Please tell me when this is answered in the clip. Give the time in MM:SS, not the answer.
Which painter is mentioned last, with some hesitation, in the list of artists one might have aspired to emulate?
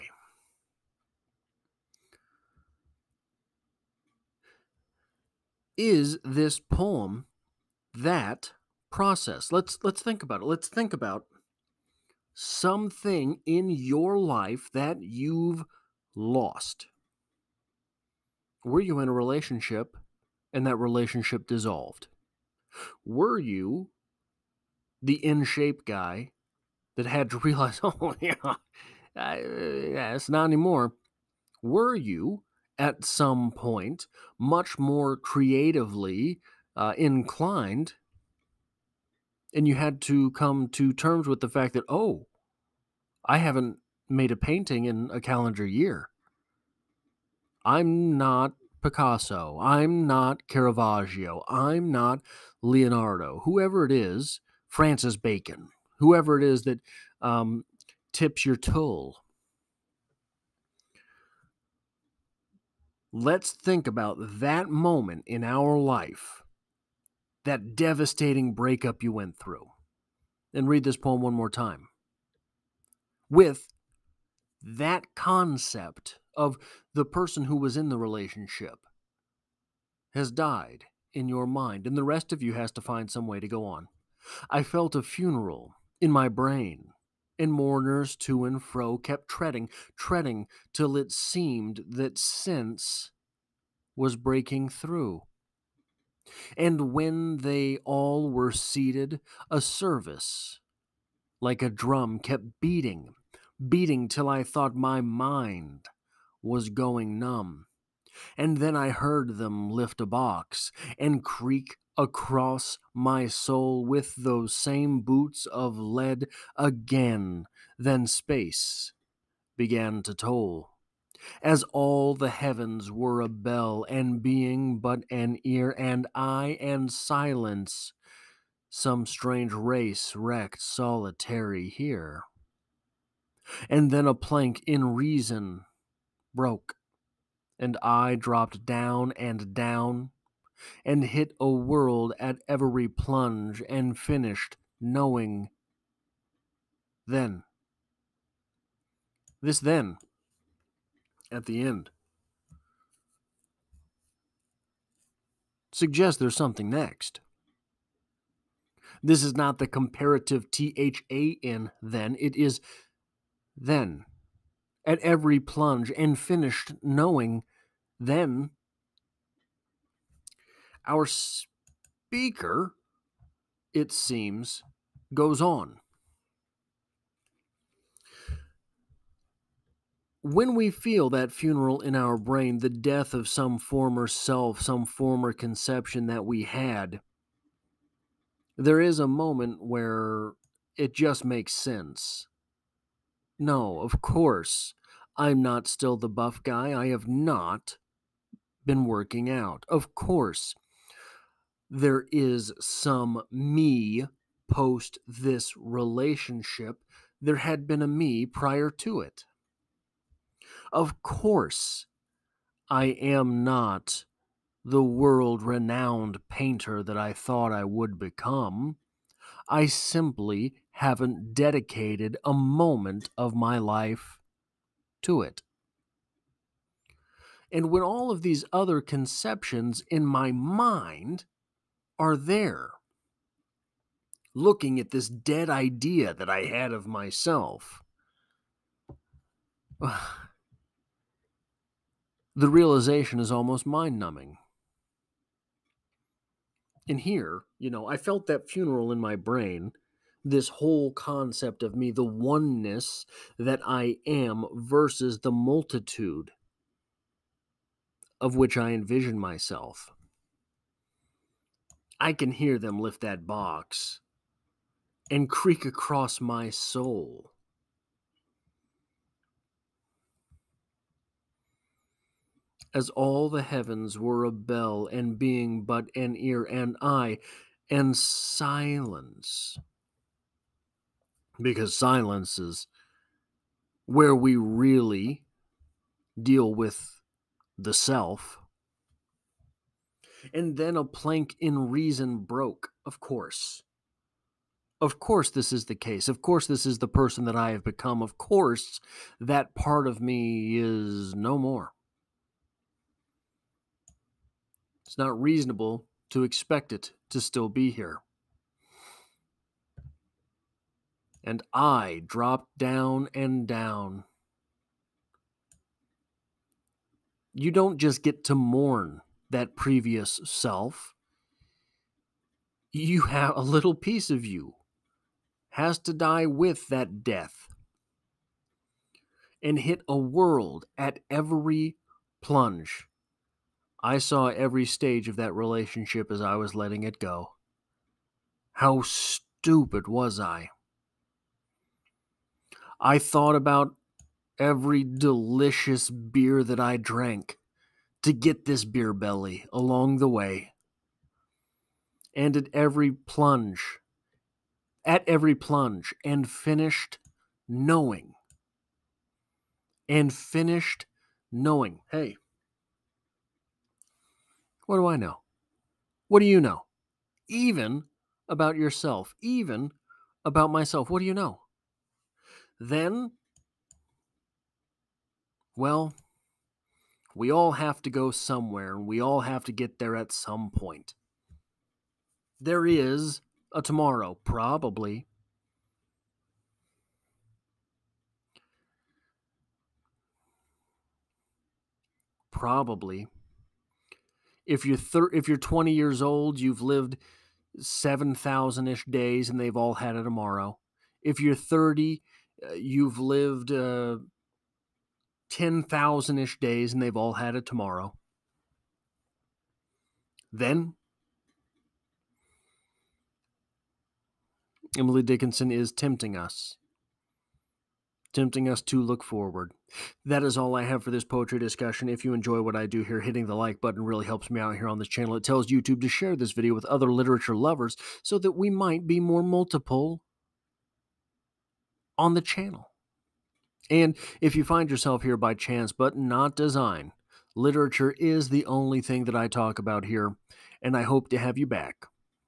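00:54.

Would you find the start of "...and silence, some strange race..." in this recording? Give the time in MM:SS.
02:06.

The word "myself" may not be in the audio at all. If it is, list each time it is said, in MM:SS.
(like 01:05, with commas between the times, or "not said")
03:56, 04:19, 06:10.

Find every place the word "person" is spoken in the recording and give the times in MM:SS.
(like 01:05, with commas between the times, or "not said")
01:17, 04:56.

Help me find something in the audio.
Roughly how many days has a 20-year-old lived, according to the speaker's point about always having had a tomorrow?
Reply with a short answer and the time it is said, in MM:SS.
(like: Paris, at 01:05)
7,000, at 06:37.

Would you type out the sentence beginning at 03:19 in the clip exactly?
Of course, there is some me post this relationship.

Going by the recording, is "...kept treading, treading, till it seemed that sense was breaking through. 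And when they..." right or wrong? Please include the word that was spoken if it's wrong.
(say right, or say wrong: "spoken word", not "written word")
right.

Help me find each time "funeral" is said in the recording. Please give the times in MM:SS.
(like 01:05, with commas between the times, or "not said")
01:25, 03:01, 04:08.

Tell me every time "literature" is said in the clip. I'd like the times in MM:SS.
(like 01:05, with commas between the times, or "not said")
07:06, 07:17.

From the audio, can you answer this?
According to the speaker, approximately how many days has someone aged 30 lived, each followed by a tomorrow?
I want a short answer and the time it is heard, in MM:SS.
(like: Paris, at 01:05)
10,000, at 06:45.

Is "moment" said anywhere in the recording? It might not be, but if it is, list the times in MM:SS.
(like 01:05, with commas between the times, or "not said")
01:04, 03:09, 03:42.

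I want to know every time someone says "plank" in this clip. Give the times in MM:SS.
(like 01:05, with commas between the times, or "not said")
02:14, 04:50.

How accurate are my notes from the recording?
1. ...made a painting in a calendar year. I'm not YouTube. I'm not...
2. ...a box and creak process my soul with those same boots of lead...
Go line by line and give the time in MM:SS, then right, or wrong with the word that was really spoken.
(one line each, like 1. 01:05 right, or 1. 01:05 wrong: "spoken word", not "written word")
1. 00:44 wrong: "Picasso", not "YouTube"
2. 01:50 wrong: "across", not "process".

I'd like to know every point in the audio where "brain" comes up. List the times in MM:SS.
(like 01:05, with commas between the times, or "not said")
01:26, 03:02, 04:09.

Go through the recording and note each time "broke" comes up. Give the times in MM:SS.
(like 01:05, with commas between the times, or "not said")
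02:16, 04:52.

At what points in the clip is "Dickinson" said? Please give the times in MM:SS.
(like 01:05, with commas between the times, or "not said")
06:55.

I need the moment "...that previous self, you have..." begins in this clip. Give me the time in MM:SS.
05:19.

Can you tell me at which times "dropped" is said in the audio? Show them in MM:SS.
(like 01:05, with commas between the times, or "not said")
02:18, 05:12.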